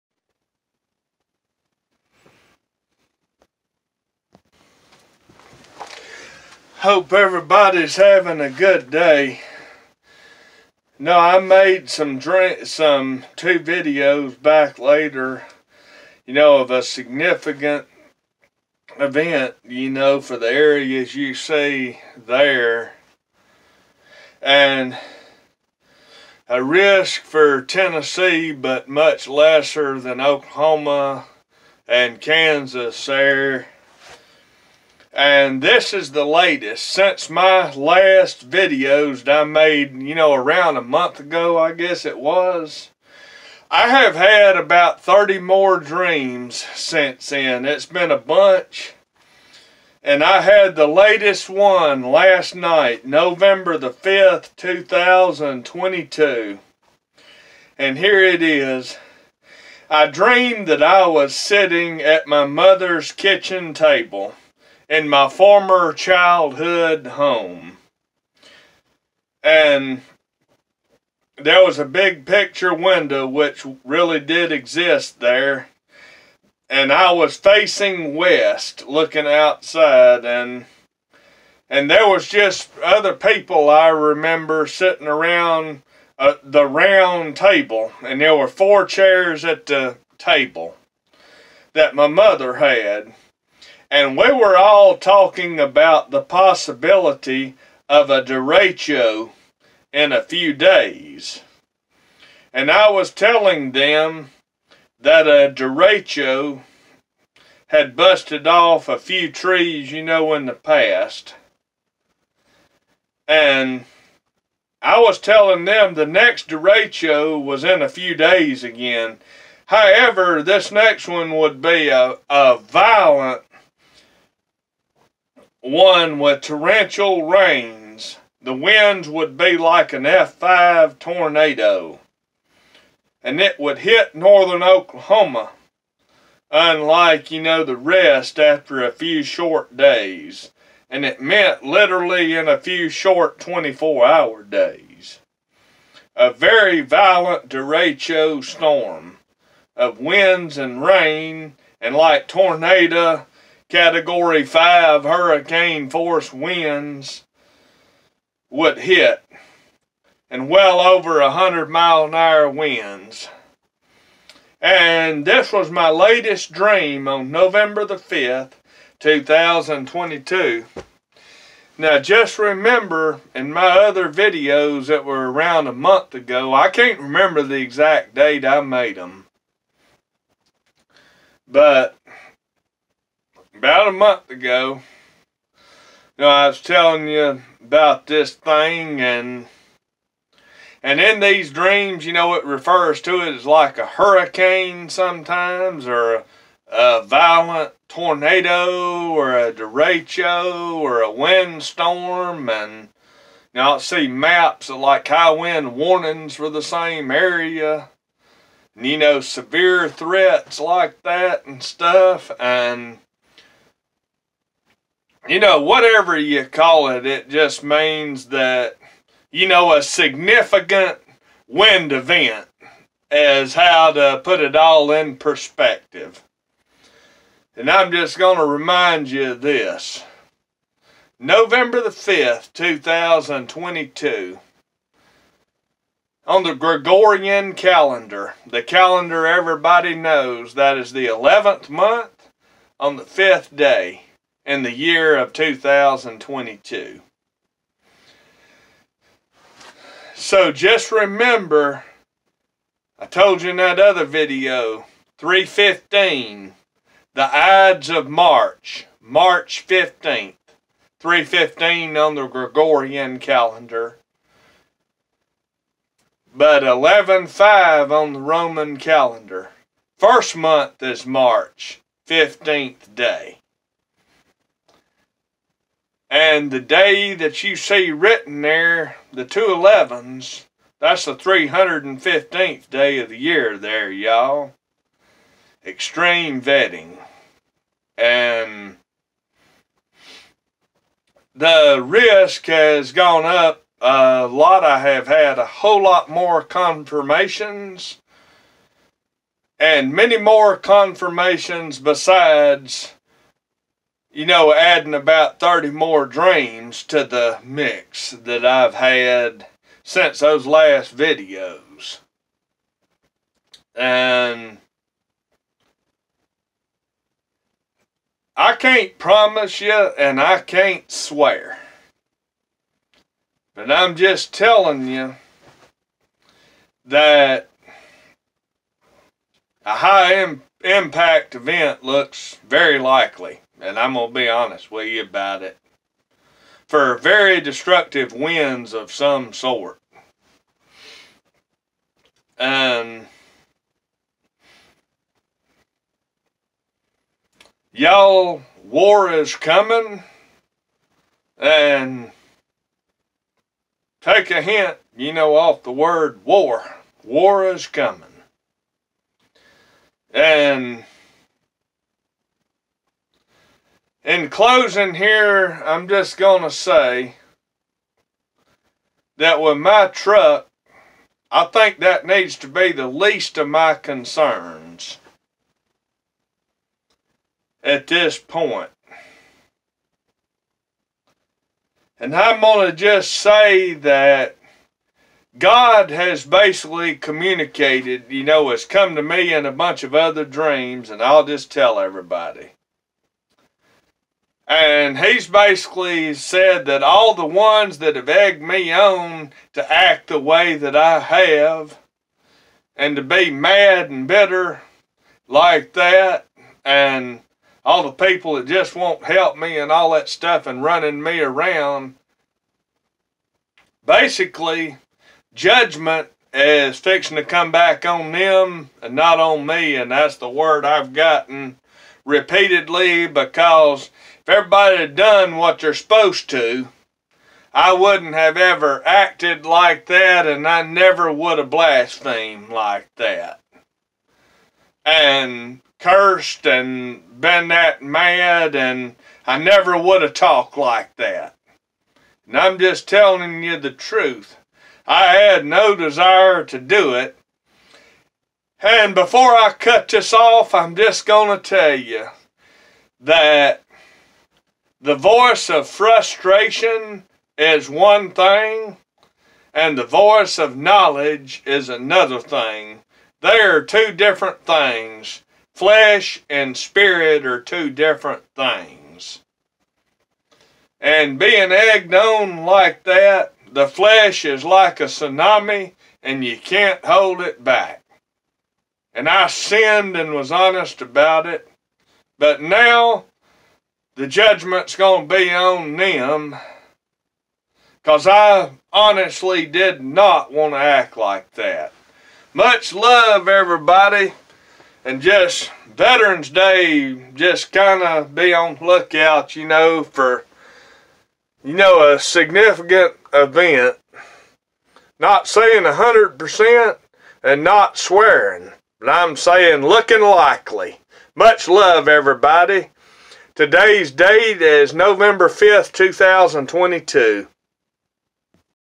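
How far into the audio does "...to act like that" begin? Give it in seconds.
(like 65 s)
490 s.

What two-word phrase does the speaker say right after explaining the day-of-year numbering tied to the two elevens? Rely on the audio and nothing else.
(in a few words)
Extreme vetting.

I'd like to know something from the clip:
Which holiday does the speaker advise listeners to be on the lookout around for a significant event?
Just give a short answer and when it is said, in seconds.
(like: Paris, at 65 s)
Veterans Day, at 495 s.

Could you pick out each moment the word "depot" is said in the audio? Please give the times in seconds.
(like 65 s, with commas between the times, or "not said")
not said.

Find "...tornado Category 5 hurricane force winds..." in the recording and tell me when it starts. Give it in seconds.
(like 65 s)
152 s.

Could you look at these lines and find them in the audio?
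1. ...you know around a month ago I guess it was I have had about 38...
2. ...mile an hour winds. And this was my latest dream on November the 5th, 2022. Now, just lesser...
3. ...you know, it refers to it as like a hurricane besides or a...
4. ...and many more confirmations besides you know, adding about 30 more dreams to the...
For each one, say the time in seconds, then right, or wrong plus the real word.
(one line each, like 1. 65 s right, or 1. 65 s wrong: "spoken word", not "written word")
1. 40 s wrong: "30", not "38"
2. 161 s wrong: "remember", not "lesser"
3. 192 s wrong: "sometimes", not "besides"
4. 299 s right.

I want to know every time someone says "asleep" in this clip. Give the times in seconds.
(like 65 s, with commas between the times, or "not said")
not said.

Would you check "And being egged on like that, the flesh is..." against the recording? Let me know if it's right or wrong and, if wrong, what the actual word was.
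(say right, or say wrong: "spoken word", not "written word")
right.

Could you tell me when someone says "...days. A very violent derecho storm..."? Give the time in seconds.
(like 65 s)
144 s.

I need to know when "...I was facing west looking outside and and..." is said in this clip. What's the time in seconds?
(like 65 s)
76 s.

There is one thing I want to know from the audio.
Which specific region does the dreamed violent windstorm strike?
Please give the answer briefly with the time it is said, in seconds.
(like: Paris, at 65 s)
Northern Oklahoma, at 134 s.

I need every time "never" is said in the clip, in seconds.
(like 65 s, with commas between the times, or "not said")
430 s, 439 s.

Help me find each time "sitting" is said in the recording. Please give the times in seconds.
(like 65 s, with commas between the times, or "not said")
61 s, 84 s.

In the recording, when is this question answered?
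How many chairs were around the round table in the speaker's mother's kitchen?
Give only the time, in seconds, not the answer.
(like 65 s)
88 s.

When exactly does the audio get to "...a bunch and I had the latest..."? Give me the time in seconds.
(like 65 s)
48 s.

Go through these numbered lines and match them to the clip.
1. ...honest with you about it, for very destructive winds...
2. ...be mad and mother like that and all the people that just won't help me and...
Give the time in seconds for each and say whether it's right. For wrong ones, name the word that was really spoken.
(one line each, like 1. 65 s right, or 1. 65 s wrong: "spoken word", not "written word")
1. 334 s right
2. 403 s wrong: "bitter", not "mother".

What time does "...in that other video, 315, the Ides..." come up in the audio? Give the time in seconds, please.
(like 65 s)
253 s.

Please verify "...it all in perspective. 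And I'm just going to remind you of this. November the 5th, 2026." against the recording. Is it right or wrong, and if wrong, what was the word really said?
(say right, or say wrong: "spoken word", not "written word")
wrong: "2022", not "2026".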